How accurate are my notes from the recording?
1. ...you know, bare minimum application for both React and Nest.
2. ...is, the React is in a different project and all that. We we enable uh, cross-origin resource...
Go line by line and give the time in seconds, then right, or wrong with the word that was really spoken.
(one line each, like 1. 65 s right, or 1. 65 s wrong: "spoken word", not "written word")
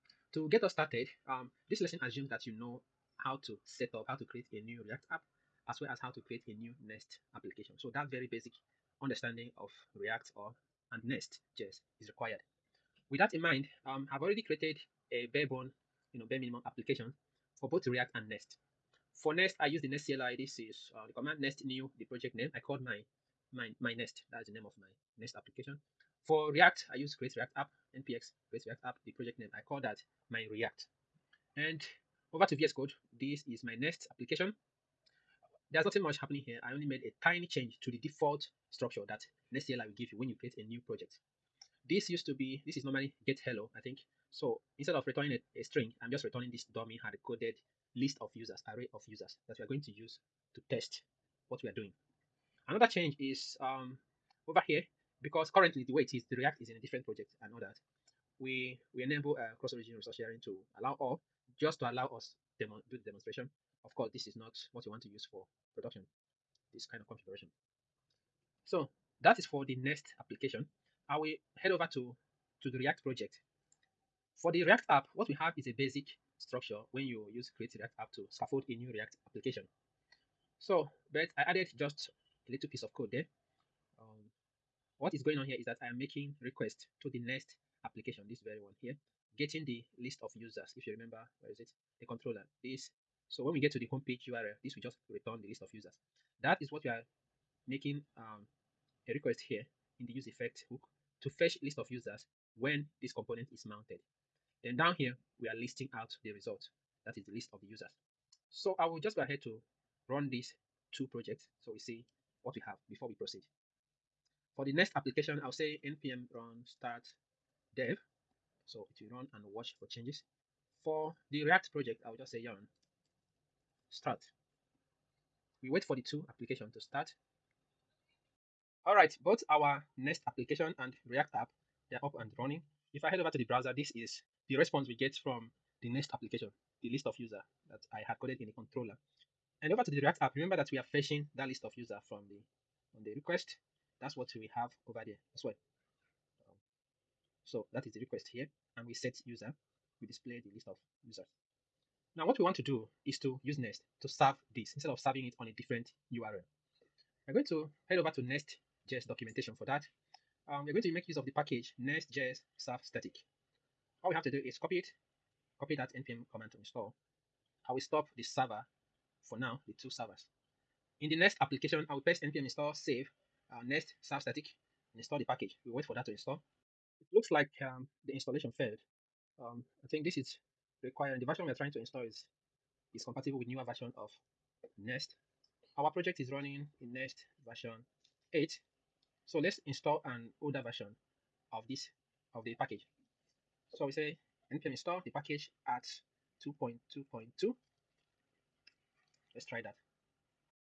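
1. 16 s right
2. 56 s right.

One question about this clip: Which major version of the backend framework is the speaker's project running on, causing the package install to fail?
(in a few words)
8.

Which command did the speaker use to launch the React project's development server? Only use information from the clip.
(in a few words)
yarn start.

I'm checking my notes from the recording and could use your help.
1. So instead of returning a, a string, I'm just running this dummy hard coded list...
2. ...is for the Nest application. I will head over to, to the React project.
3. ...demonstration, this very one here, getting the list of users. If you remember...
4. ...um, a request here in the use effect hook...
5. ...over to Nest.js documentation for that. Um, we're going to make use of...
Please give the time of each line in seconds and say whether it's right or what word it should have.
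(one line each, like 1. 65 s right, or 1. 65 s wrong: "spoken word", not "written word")
1. 44 s wrong: "returning", not "running"
2. 69 s right
3. 87 s wrong: "application", not "demonstration"
4. 98 s right
5. 157 s right.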